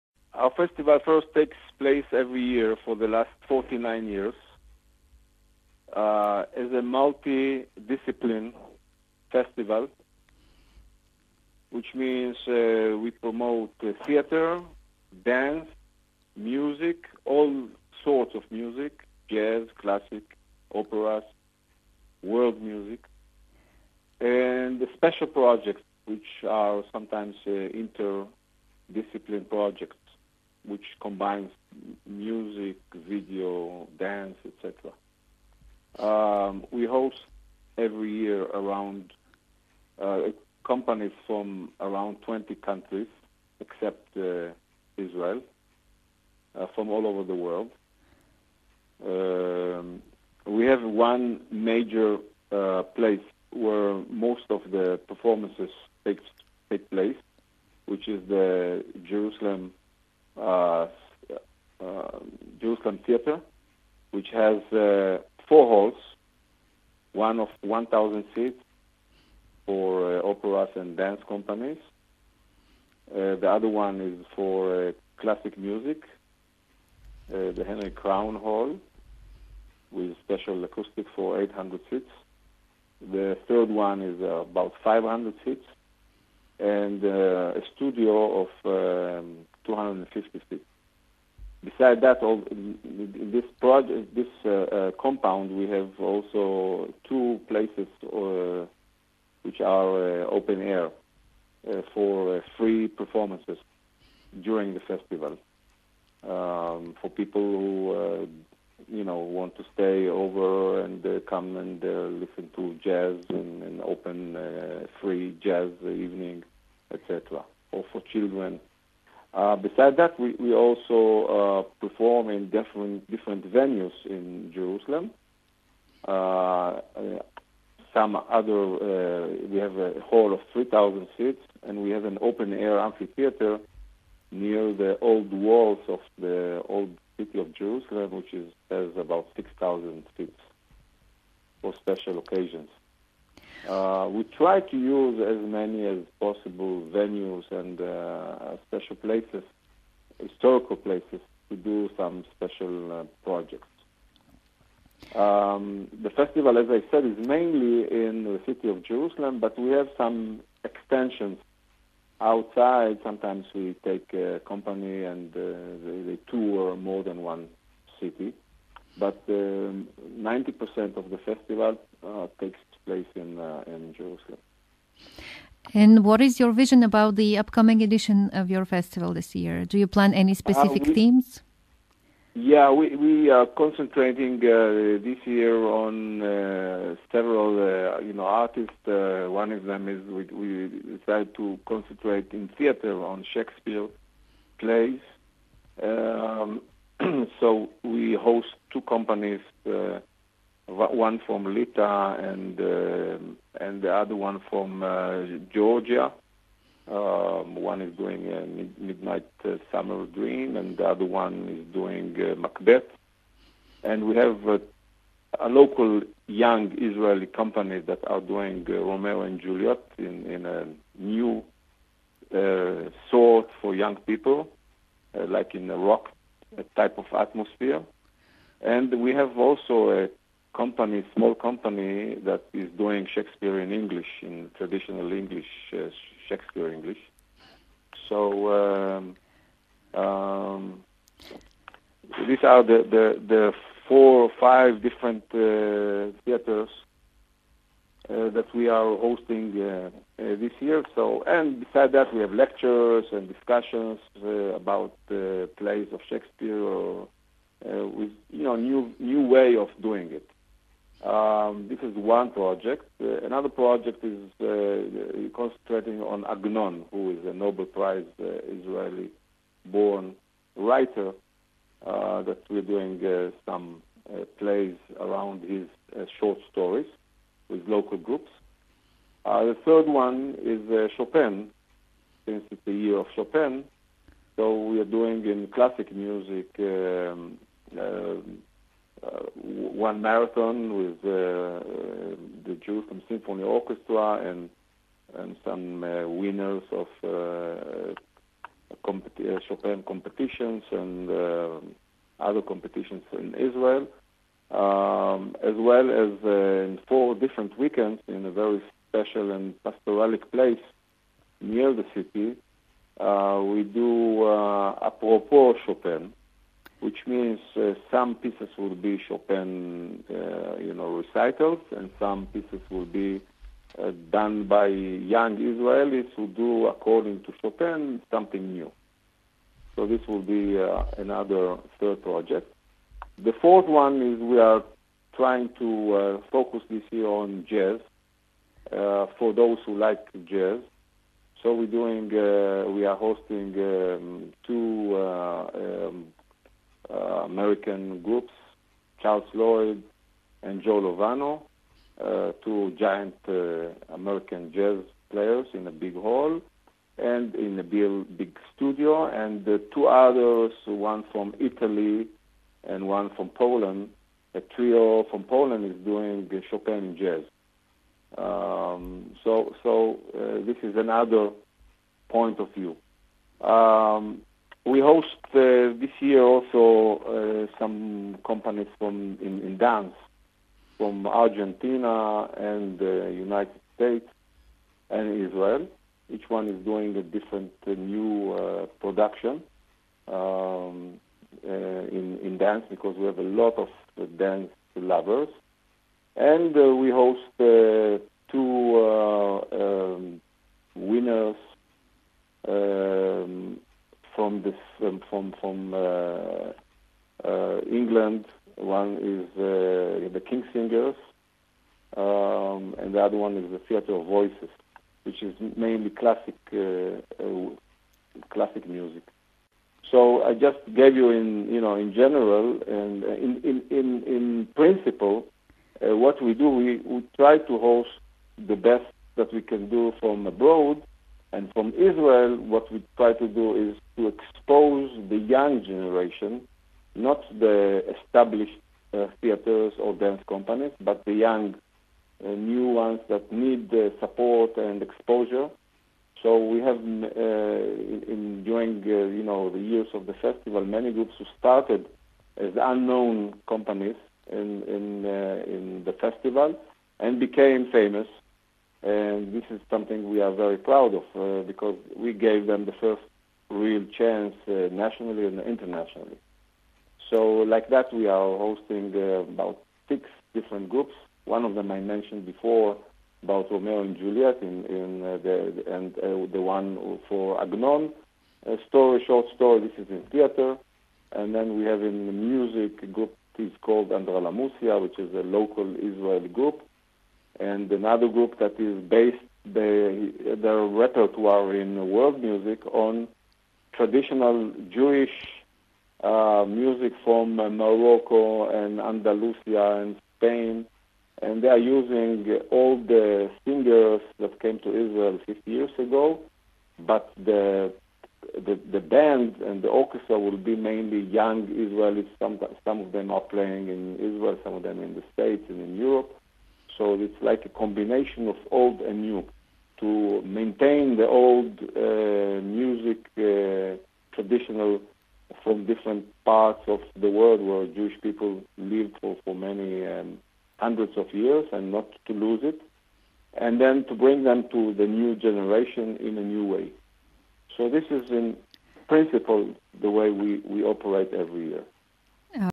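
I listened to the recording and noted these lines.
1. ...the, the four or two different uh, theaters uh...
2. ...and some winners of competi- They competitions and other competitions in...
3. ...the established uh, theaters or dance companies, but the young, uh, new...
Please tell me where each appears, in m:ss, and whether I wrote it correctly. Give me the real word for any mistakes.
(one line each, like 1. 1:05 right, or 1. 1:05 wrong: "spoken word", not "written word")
1. 4:02 wrong: "five", not "two"
2. 4:55 wrong: "Chopin", not "They"
3. 7:17 right.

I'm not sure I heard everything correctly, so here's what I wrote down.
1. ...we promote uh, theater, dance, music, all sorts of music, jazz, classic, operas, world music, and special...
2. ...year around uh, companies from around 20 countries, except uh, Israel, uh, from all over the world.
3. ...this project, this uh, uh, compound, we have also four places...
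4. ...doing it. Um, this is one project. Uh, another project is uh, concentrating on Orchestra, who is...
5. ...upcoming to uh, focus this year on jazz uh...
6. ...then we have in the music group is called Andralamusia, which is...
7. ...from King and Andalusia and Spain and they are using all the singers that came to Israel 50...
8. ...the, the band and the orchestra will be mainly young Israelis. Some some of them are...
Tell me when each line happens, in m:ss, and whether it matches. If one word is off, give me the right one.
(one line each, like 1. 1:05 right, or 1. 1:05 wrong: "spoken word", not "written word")
1. 0:12 right
2. 0:38 right
3. 1:32 wrong: "two", not "four"
4. 4:19 wrong: "Agnon", not "Orchestra"
5. 5:35 wrong: "trying", not "upcoming"
6. 8:01 right
7. 8:17 wrong: "Morocco", not "King"
8. 8:28 right.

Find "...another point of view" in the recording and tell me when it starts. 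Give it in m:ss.
6:10.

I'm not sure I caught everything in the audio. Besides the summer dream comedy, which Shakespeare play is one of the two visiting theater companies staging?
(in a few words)
Macbeth.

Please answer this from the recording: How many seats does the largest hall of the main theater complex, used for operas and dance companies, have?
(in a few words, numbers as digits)
1,000.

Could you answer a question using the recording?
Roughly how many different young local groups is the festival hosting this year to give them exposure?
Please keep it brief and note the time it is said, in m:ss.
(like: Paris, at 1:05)
6, at 7:49.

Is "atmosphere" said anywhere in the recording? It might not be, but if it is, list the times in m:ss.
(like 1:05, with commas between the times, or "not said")
3:47.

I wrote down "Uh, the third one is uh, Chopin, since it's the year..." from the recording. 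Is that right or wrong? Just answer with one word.
right.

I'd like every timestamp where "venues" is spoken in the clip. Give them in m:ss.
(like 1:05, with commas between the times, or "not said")
2:03, 2:26.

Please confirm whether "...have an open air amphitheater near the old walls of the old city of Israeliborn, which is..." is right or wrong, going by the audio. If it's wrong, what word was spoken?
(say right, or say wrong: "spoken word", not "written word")
wrong: "Jerusalem", not "Israeliborn".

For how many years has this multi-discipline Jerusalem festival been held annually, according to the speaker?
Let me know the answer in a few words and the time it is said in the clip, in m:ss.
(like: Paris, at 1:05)
49, at 0:03.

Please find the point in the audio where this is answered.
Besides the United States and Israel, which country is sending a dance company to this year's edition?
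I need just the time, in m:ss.
6:21.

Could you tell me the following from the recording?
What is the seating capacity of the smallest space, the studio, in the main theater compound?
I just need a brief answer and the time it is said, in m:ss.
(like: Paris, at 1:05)
250, at 1:29.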